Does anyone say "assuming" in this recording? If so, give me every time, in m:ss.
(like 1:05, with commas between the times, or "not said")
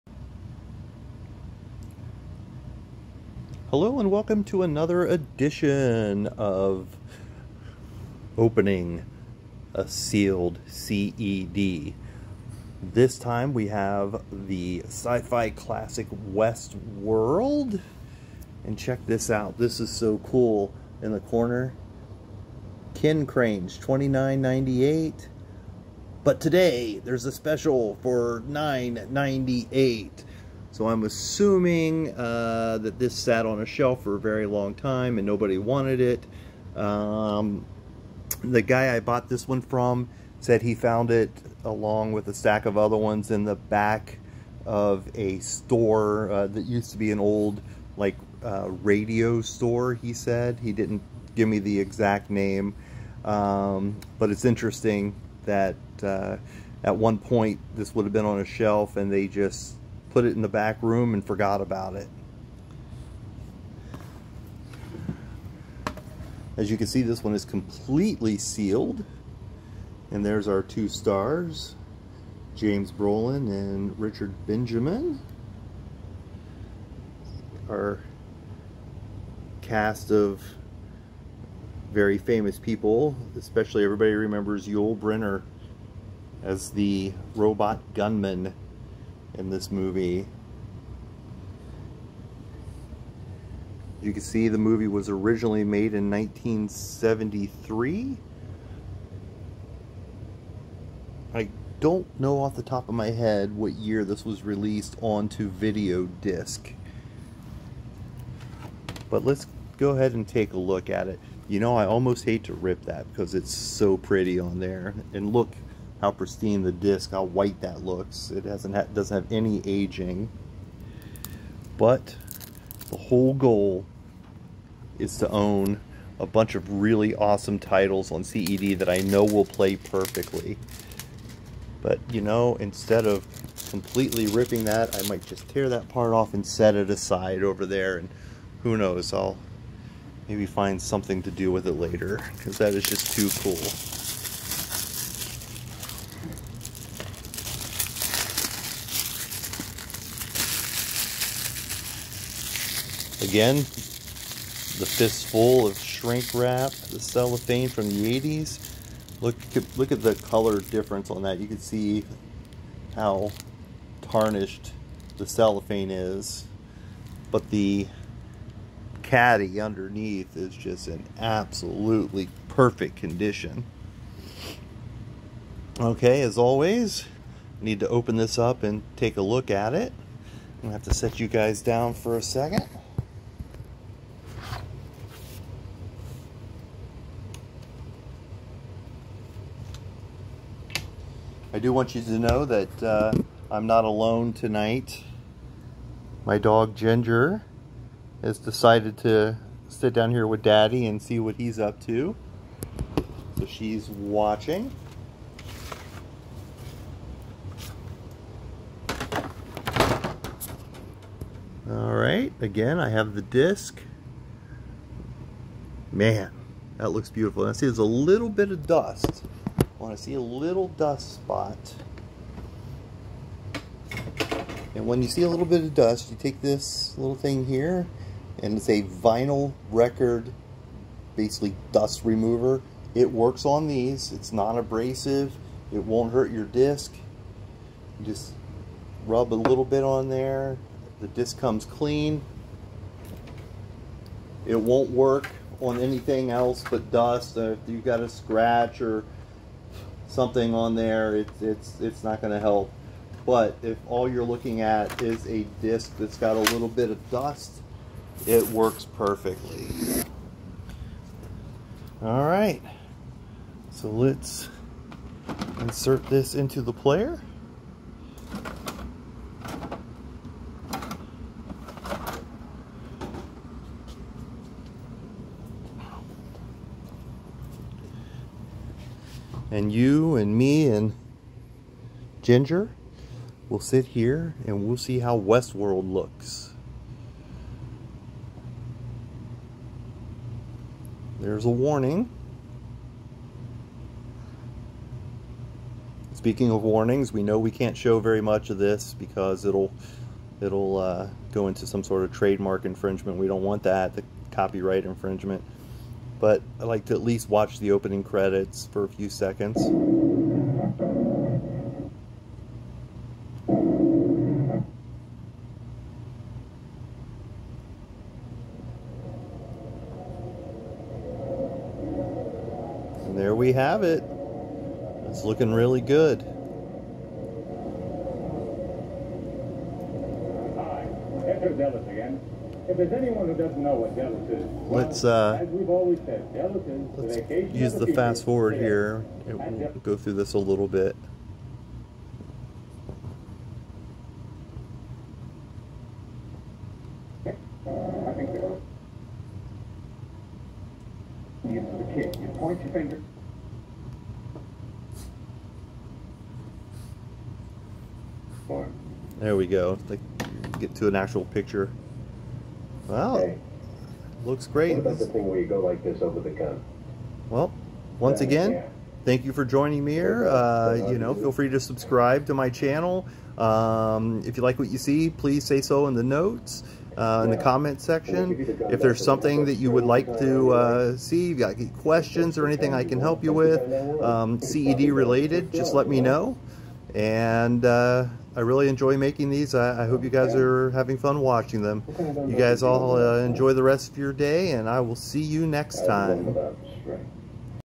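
0:31.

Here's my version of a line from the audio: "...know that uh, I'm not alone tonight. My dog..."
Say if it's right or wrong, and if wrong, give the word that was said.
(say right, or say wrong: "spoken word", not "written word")
right.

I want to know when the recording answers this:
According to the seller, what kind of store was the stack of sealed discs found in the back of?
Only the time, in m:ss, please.
0:48.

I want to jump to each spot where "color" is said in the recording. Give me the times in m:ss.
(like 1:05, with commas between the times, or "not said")
2:40.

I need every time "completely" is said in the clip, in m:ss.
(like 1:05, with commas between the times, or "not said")
1:07, 2:13.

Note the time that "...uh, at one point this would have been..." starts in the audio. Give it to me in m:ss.
0:56.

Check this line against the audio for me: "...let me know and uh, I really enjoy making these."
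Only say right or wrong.
right.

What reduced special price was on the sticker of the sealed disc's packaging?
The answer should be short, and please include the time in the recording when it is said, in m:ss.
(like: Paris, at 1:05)
$9.98, at 0:28.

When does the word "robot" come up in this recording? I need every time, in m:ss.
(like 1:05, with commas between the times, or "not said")
1:27.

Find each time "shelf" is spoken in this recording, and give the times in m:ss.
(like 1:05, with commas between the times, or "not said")
0:33, 0:58.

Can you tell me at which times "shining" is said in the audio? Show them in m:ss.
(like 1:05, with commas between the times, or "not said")
not said.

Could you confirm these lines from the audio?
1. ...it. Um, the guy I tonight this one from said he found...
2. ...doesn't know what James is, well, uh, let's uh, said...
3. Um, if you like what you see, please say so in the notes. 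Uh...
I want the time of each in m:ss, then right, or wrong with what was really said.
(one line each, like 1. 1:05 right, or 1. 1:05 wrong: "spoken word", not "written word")
1. 0:35 wrong: "bought", not "tonight"
2. 5:33 wrong: "Dallas", not "James"
3. 6:13 right.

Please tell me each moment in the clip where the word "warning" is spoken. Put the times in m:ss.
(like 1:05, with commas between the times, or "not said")
4:51, 4:56.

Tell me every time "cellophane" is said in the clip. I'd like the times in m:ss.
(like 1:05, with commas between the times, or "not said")
2:36, 2:45.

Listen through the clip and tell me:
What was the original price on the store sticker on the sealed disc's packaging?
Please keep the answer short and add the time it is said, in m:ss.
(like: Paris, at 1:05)
$29.98, at 0:23.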